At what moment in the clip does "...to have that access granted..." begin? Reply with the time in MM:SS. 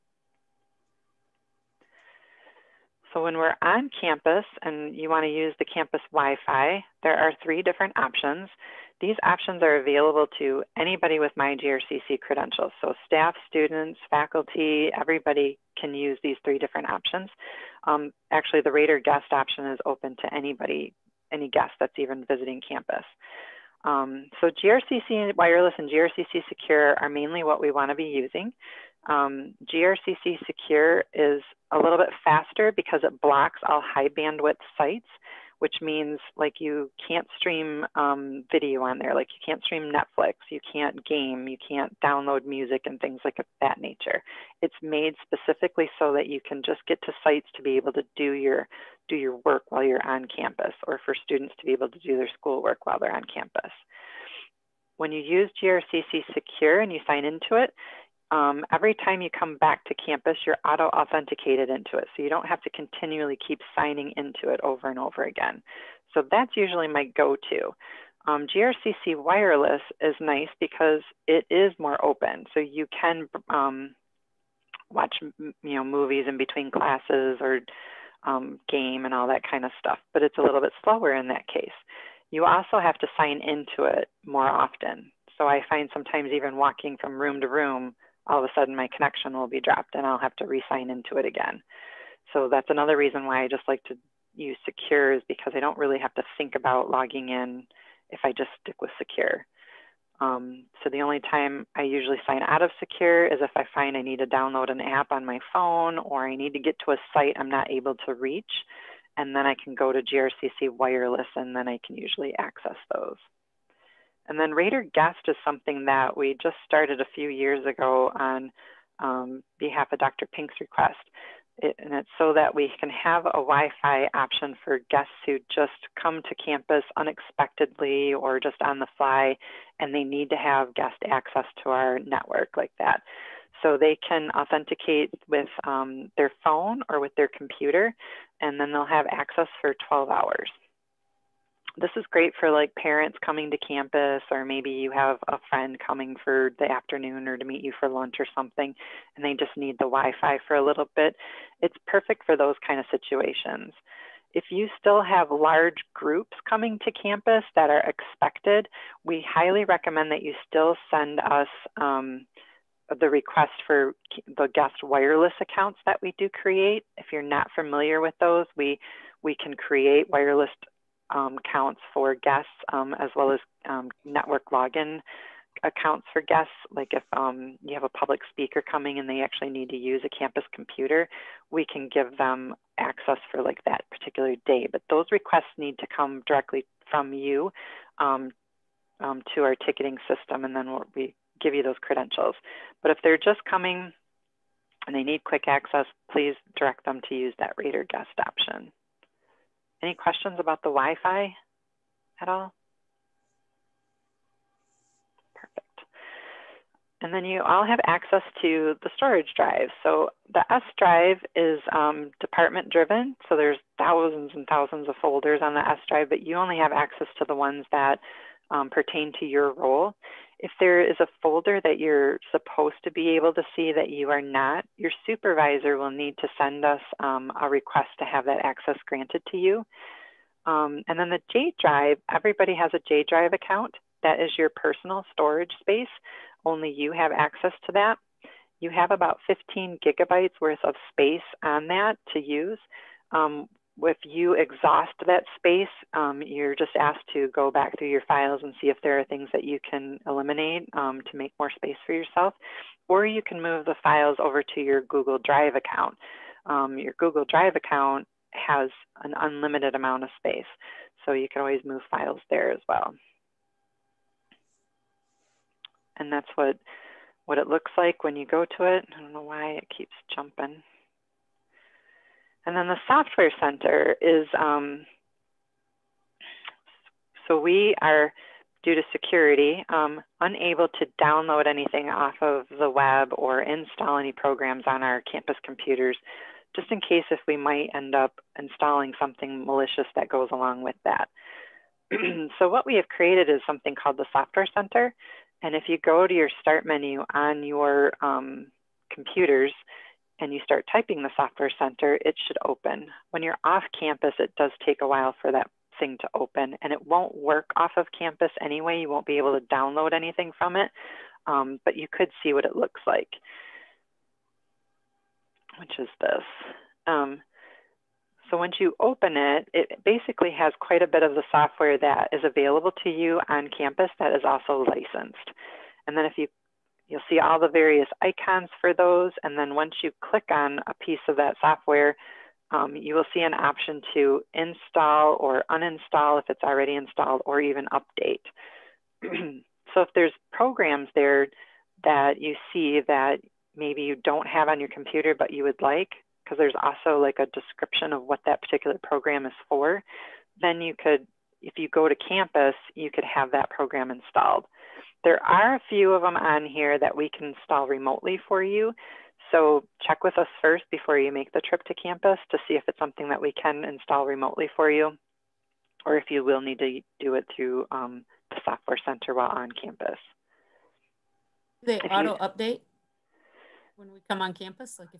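03:47.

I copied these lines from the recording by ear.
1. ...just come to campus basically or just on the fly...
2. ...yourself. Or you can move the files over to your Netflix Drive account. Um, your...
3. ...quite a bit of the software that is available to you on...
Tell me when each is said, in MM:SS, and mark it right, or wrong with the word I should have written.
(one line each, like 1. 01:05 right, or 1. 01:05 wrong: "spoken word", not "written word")
1. 02:05 wrong: "unexpectedly", not "basically"
2. 04:11 wrong: "Google", not "Netflix"
3. 05:20 right.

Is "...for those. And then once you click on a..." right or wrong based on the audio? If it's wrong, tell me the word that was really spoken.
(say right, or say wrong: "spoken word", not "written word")
right.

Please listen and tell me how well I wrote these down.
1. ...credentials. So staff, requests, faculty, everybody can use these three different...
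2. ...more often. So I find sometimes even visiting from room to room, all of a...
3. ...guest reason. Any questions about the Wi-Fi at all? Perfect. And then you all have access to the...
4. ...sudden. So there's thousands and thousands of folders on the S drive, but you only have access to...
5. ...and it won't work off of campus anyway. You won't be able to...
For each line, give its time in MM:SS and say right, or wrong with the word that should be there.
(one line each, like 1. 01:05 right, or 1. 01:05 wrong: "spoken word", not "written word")
1. 00:12 wrong: "students", not "requests"
2. 01:24 wrong: "walking", not "visiting"
3. 03:17 wrong: "option", not "reason"
4. 03:32 wrong: "driven", not "sudden"
5. 05:06 right.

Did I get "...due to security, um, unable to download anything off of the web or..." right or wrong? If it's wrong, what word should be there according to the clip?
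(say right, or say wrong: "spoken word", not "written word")
right.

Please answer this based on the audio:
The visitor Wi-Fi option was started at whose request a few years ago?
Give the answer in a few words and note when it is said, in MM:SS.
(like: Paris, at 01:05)
Dr. Pink, at 01:59.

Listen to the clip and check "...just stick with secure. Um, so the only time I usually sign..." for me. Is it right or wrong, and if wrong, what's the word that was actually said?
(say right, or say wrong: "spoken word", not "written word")
right.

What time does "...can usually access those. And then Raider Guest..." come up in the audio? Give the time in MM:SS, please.
01:51.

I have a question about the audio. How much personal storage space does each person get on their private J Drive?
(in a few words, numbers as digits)
15 gigabytes.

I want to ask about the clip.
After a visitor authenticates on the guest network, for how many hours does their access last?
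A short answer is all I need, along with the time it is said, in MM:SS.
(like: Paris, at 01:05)
12, at 02:19.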